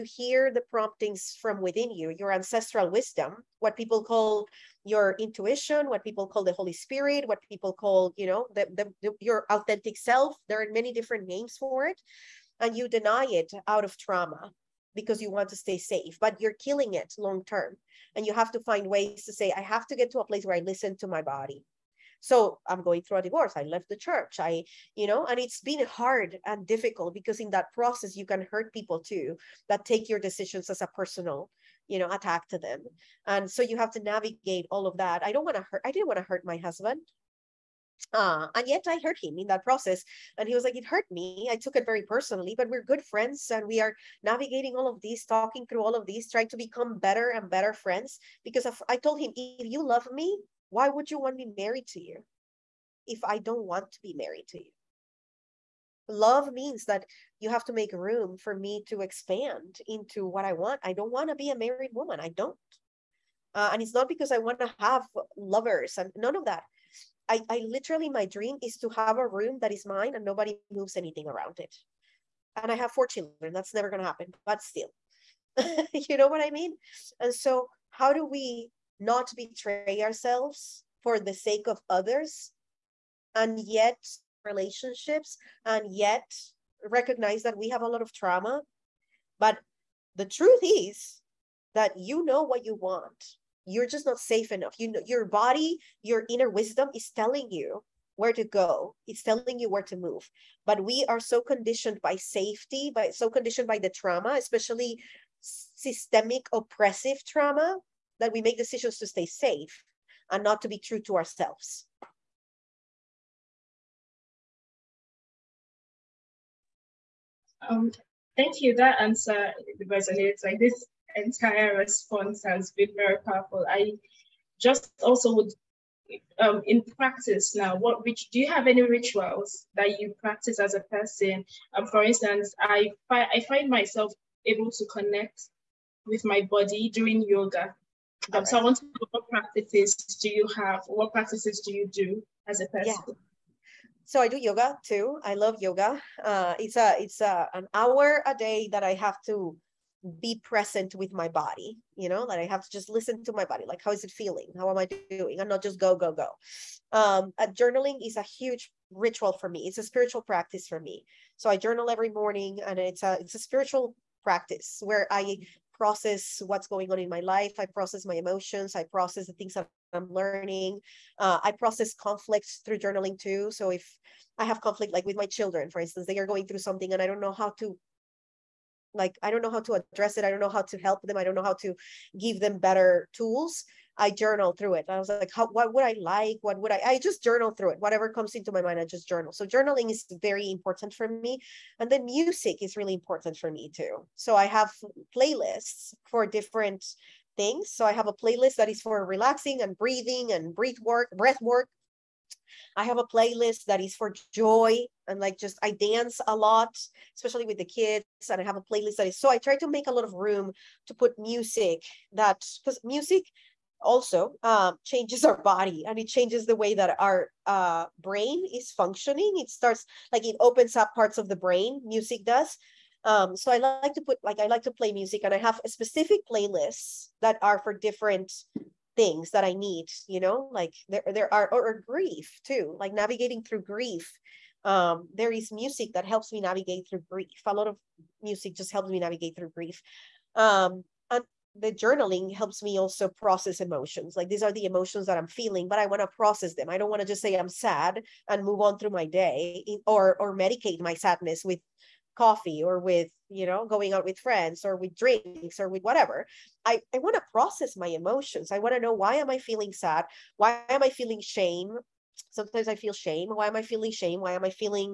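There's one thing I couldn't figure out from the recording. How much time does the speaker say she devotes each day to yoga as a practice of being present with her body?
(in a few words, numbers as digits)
an hour.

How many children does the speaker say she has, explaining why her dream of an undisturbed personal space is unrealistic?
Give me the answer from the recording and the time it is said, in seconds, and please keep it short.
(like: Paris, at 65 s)
4, at 72 s.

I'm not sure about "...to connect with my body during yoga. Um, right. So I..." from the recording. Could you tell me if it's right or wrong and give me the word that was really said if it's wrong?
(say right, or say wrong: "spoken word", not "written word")
right.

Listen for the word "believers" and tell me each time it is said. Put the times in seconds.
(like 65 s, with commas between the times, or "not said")
not said.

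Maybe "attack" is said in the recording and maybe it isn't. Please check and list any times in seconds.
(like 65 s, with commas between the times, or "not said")
32 s.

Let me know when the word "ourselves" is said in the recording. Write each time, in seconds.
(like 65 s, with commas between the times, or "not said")
80 s, 111 s.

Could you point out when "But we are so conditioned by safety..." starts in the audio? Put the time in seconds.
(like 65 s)
100 s.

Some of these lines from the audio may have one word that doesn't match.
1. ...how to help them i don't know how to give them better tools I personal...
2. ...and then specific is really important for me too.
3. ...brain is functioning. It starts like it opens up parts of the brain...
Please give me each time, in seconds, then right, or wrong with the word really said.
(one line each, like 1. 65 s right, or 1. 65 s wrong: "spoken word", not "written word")
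1. 180 s wrong: "journal", not "personal"
2. 191 s wrong: "music", not "specific"
3. 217 s right.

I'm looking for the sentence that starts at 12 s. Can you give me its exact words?
And you deny it out of trauma because you want to stay safe, but you're killing it long term.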